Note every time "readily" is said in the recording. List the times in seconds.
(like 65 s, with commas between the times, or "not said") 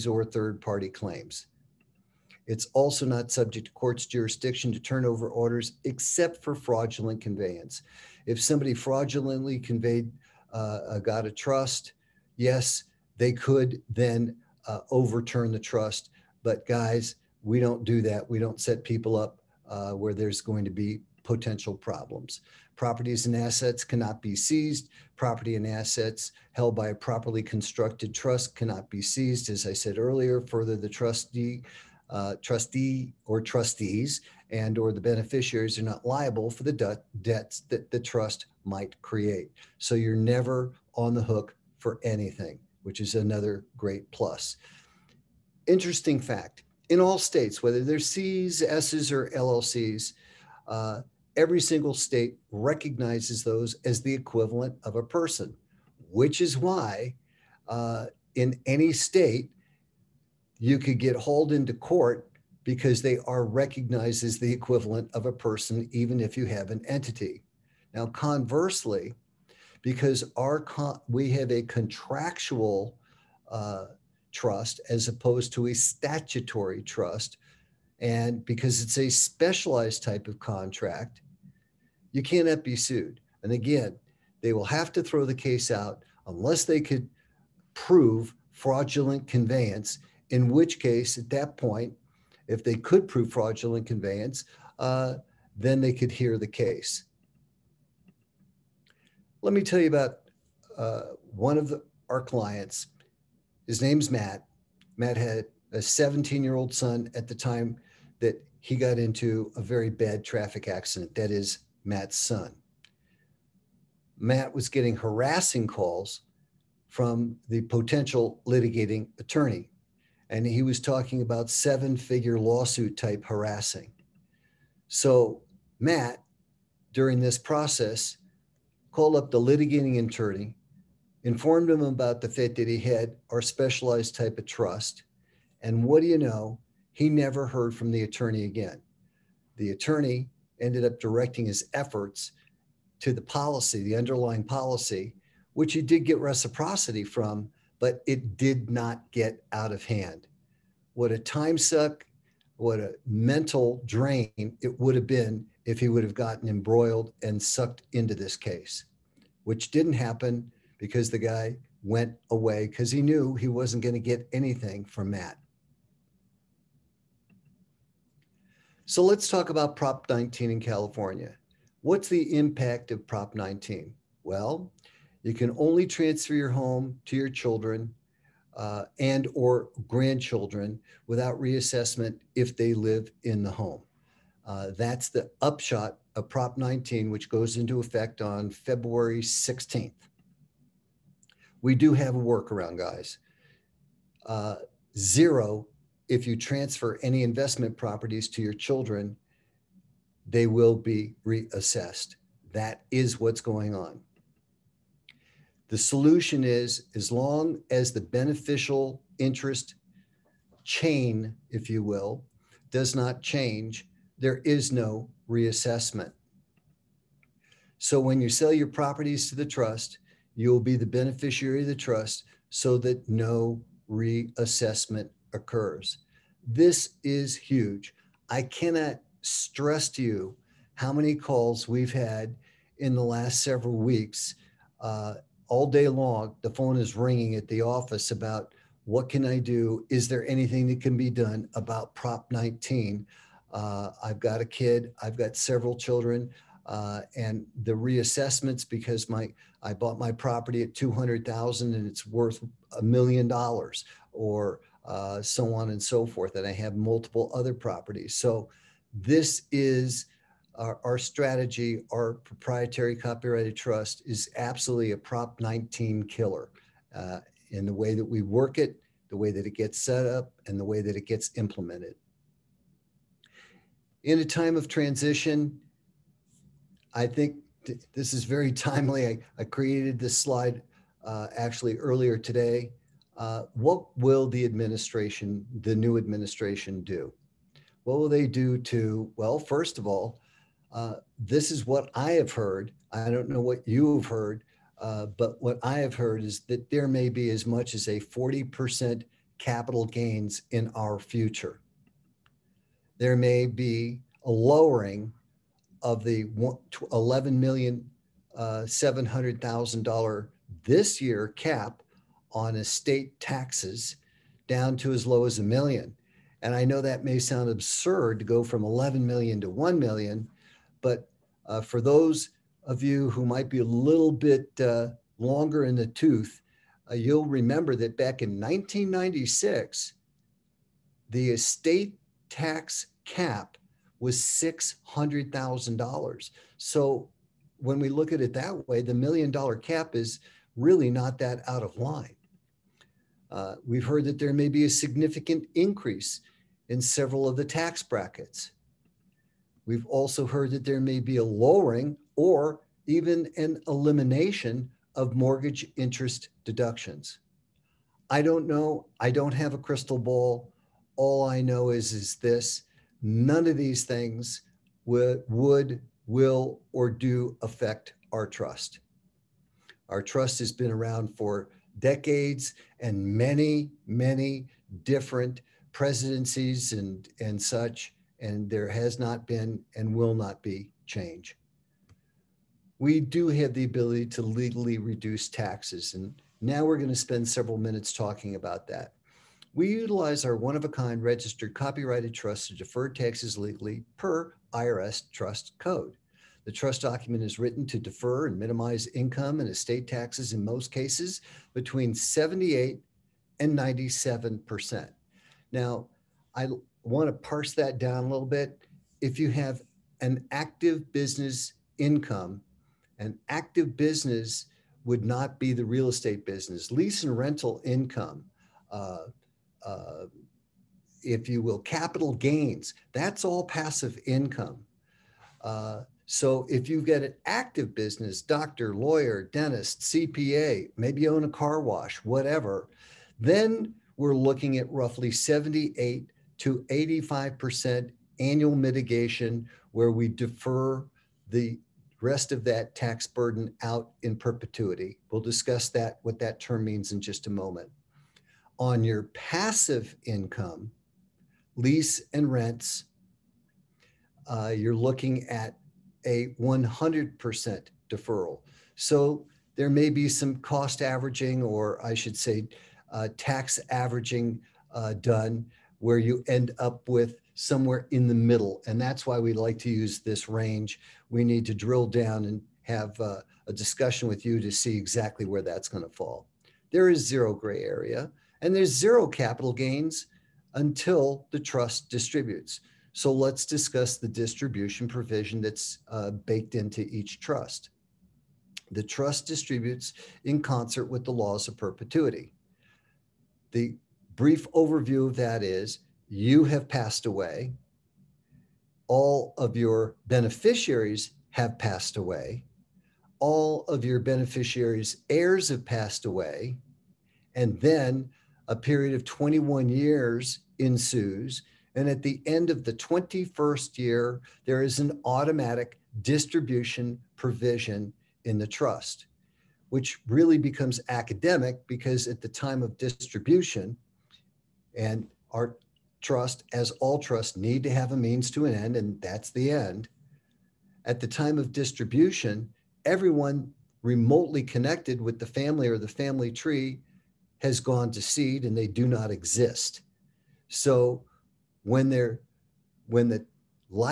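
not said.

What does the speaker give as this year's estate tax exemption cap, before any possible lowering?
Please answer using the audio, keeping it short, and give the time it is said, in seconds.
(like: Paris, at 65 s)
$11,700,000, at 306 s.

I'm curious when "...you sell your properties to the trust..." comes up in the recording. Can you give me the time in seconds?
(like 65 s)
218 s.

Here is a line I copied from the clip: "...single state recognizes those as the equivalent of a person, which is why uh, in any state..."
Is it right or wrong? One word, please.
right.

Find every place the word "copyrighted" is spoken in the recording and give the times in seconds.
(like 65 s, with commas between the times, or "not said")
262 s, 391 s.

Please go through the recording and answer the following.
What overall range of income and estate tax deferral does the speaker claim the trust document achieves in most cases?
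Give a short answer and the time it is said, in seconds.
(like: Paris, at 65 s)
78 to 97%, at 401 s.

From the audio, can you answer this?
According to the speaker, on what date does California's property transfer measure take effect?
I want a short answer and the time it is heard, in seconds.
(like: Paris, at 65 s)
February 16th, at 188 s.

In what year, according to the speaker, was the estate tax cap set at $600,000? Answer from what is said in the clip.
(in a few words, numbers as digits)
1996.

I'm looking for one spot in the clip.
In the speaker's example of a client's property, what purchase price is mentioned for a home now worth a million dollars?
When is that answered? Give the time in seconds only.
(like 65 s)
250 s.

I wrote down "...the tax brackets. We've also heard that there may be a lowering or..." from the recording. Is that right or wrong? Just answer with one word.
right.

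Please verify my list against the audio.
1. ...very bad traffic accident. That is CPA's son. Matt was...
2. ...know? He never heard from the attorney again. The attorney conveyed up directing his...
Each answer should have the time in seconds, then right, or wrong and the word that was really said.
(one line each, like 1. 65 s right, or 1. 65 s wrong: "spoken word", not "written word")
1. 109 s wrong: "Matt", not "CPA"
2. 136 s wrong: "ended", not "conveyed".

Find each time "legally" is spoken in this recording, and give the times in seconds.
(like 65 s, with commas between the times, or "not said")
384 s, 393 s.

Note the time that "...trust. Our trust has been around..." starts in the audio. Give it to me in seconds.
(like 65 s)
368 s.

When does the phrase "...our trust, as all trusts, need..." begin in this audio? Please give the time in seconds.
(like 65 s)
525 s.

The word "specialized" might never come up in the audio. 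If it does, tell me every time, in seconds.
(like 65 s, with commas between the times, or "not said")
79 s, 133 s.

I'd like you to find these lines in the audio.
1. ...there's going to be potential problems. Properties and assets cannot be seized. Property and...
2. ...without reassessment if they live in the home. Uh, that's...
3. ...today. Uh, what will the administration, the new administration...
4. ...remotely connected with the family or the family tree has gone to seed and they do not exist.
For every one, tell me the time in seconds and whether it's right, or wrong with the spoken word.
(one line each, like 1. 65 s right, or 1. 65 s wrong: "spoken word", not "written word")
1. 20 s right
2. 181 s right
3. 282 s right
4. 533 s right.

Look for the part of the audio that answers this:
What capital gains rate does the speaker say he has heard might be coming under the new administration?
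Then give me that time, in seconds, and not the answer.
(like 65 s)
297 s.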